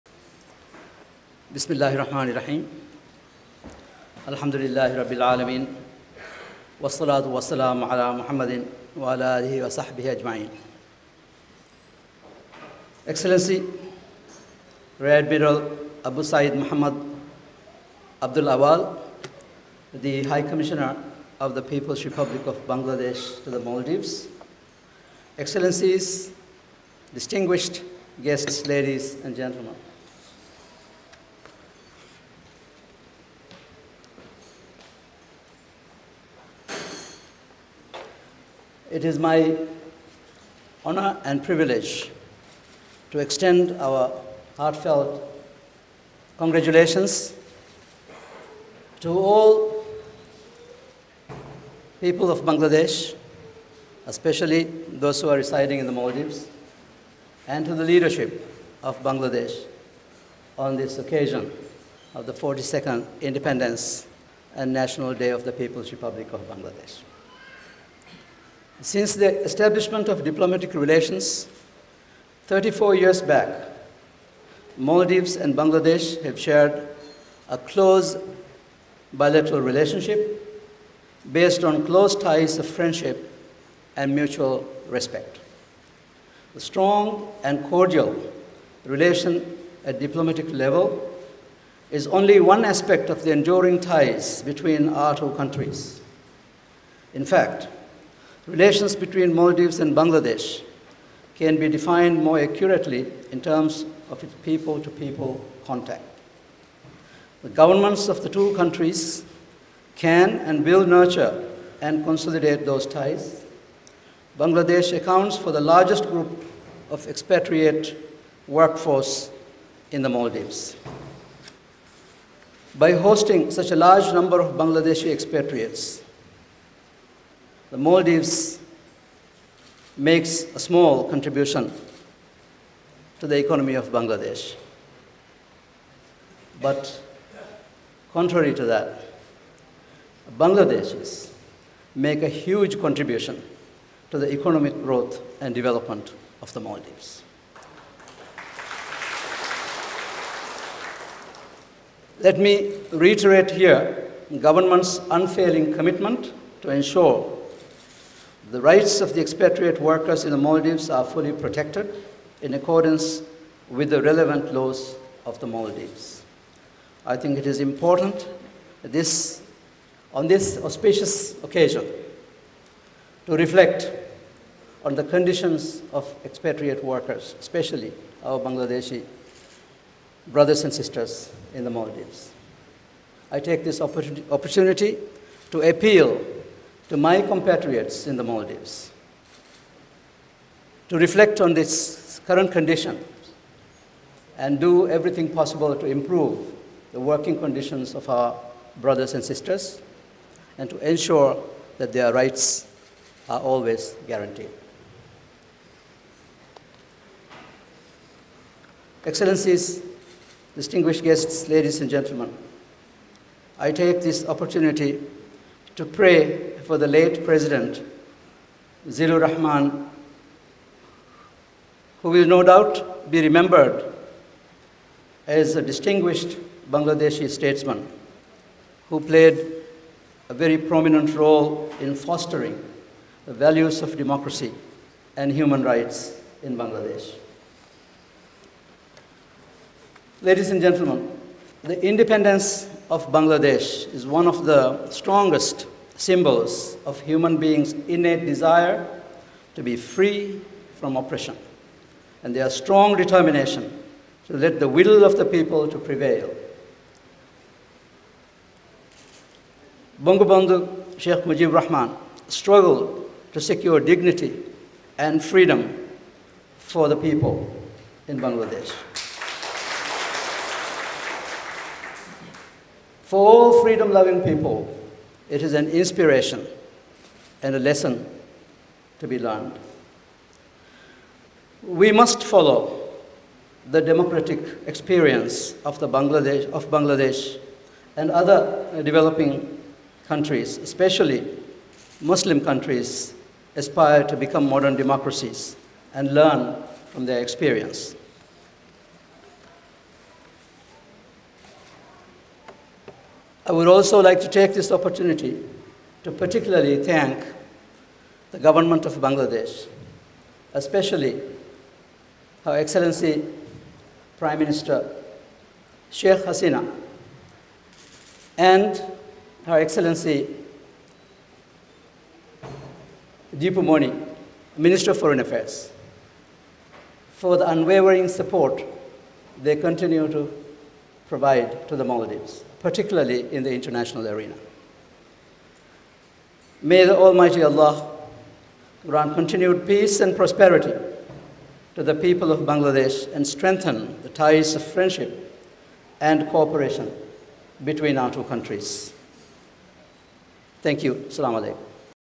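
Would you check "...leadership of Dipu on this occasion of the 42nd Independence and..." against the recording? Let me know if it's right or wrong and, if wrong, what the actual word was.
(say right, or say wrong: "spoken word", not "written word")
wrong: "Bangladesh", not "Dipu".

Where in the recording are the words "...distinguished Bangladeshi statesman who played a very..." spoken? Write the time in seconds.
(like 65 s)
225 s.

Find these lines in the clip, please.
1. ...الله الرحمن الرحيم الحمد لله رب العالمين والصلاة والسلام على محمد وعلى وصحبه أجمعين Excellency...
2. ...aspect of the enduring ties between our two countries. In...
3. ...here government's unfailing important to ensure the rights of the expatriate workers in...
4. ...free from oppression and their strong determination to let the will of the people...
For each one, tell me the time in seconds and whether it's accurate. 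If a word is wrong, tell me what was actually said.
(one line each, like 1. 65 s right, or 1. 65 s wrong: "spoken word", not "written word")
1. 1 s right
2. 92 s right
3. 153 s wrong: "commitment", not "important"
4. 249 s right.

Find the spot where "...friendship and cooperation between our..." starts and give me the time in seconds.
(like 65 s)
344 s.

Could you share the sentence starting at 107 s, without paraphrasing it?
The governments of the two countries can and will nurture and consolidate those ties.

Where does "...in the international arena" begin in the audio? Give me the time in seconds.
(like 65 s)
333 s.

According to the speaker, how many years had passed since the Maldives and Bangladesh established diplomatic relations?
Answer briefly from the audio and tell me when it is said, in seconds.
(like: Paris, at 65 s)
34, at 72 s.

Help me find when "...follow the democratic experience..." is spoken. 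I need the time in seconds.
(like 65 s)
282 s.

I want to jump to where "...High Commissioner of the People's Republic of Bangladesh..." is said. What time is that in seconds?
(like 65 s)
20 s.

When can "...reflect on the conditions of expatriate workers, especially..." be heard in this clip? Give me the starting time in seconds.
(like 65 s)
173 s.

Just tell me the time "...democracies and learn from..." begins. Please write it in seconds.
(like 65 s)
294 s.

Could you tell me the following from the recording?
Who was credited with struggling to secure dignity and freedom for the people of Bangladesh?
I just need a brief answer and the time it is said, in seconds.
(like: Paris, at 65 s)
Sheikh Mujib Rahman, at 260 s.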